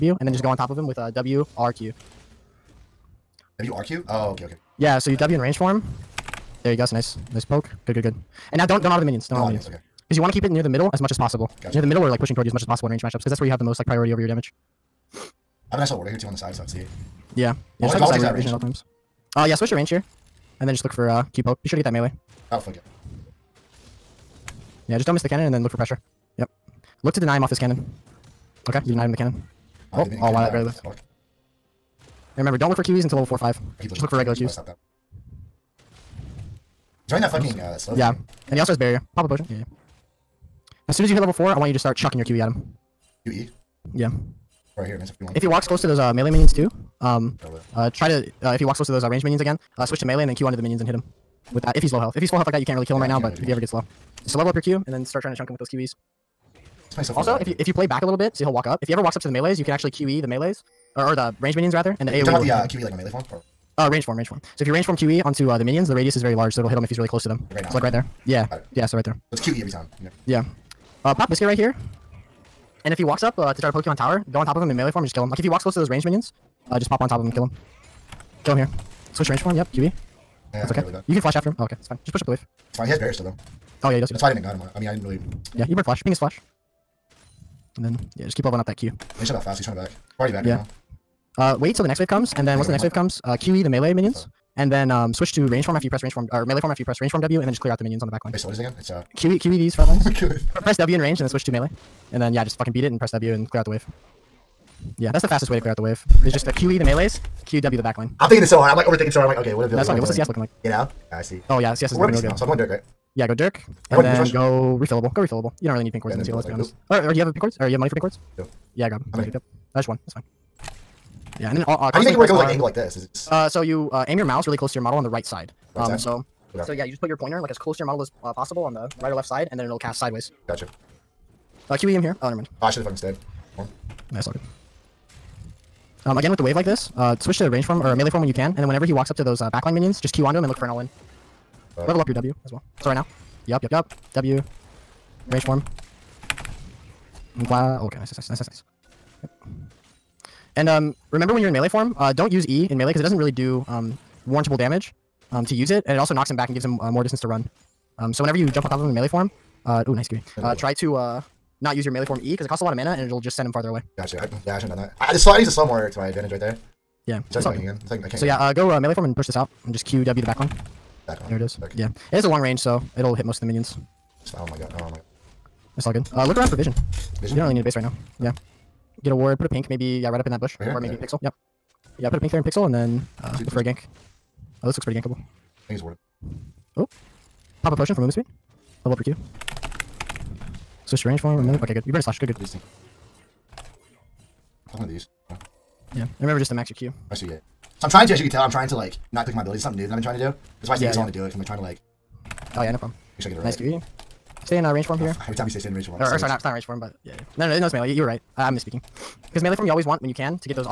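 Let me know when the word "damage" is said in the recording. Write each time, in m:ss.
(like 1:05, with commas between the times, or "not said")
0:14, 2:34.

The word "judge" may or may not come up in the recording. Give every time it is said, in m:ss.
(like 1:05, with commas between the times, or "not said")
not said.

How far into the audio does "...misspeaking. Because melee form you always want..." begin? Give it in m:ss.
3:28.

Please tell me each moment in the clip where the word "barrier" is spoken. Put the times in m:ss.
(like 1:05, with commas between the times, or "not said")
0:38, 1:22.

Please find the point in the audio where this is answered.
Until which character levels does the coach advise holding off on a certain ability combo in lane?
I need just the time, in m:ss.
0:33.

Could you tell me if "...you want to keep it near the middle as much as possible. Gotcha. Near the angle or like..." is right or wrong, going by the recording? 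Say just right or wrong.
wrong.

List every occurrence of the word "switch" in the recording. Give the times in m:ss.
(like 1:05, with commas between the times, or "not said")
0:19, 0:49, 1:19, 1:35, 1:41, 2:17, 3:10.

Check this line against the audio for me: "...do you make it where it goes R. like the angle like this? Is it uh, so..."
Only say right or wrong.
right.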